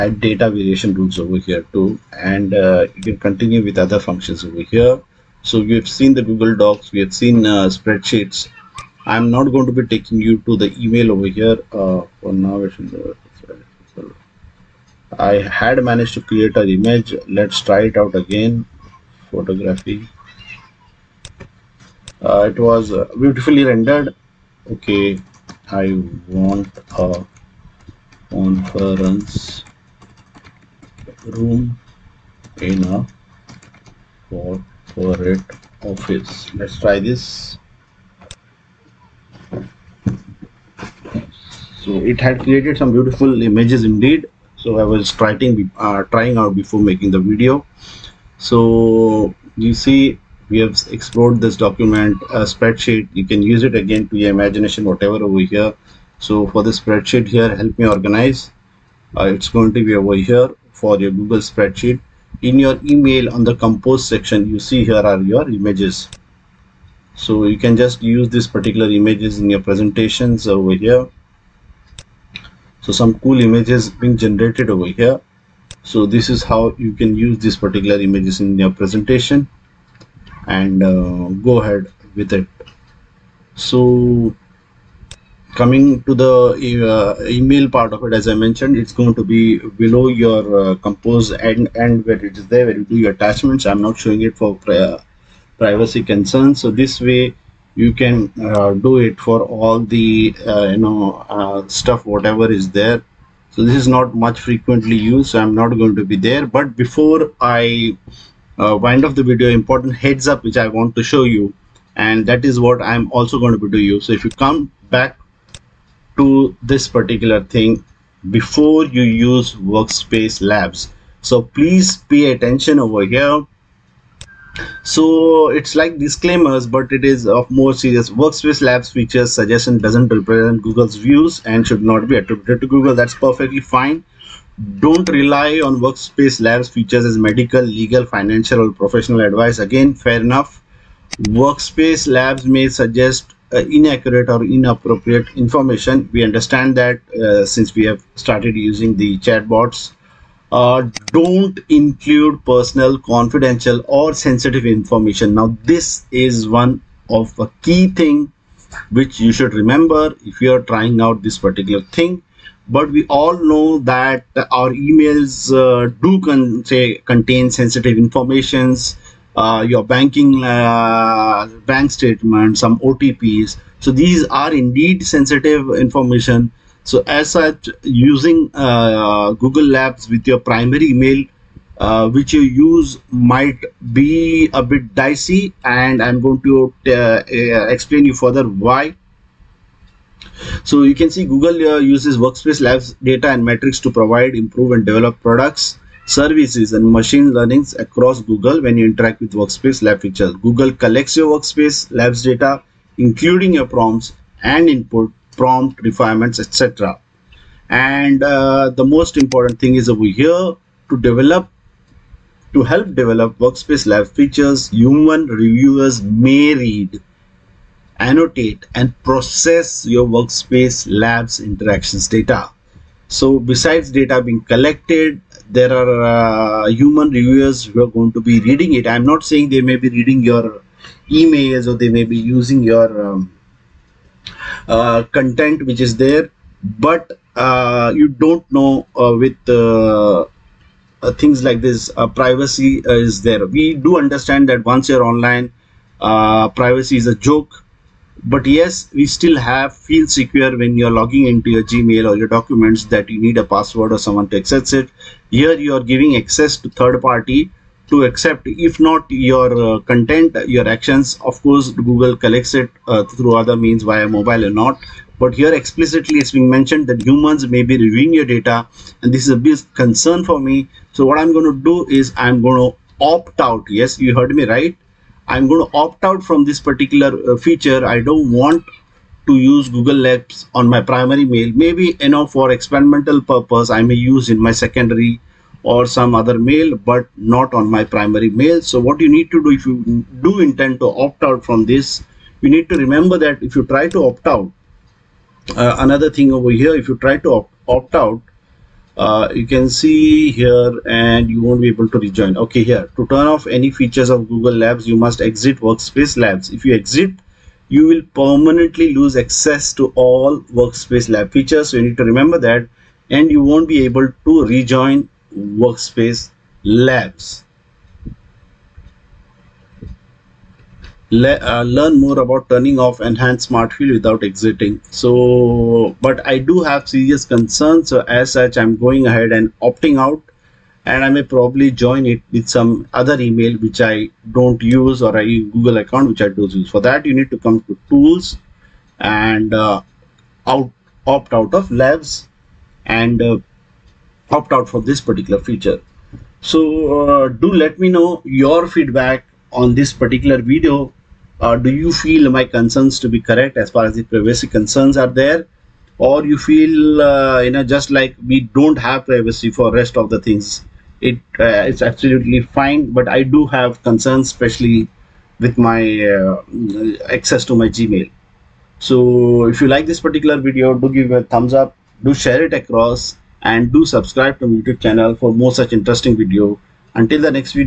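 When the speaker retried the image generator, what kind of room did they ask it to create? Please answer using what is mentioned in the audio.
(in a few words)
conference room.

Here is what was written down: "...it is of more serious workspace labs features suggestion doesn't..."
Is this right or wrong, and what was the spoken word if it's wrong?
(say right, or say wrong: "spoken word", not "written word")
right.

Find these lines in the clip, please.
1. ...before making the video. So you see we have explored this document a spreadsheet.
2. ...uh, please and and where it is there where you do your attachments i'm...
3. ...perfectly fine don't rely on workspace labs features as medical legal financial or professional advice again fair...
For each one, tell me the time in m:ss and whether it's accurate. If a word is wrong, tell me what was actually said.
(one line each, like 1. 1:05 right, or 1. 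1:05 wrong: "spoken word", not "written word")
1. 0:46 right
2. 1:30 wrong: "compose", not "please"
3. 2:13 right.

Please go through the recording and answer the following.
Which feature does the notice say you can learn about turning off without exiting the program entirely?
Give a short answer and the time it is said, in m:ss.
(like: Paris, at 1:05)
enhanced smart fill, at 5:23.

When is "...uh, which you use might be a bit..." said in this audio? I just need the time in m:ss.
3:01.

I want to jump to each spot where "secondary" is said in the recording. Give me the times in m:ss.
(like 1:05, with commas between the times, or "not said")
4:44.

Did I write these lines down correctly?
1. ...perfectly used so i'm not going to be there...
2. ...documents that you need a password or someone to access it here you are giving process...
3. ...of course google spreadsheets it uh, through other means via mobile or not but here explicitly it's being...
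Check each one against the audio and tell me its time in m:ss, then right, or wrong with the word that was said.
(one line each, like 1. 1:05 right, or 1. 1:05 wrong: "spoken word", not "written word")
1. 1:44 wrong: "frequently", not "perfectly"
2. 4:12 wrong: "access", not "process"
3. 4:21 wrong: "collects", not "spreadsheets".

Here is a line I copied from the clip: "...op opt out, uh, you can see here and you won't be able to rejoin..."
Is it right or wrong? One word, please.
right.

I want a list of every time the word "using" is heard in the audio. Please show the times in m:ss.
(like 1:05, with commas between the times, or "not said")
2:28, 2:57, 3:52.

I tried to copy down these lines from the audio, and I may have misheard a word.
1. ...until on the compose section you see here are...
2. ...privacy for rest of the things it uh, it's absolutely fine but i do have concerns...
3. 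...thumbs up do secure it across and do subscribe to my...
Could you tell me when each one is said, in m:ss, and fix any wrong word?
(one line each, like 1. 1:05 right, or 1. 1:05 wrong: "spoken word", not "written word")
1. 1:02 wrong: "email", not "until"
2. 5:59 right
3. 6:11 wrong: "share", not "secure".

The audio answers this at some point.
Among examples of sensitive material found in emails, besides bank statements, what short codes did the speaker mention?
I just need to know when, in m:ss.
2:52.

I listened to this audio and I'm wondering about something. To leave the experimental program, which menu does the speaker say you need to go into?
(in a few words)
tools.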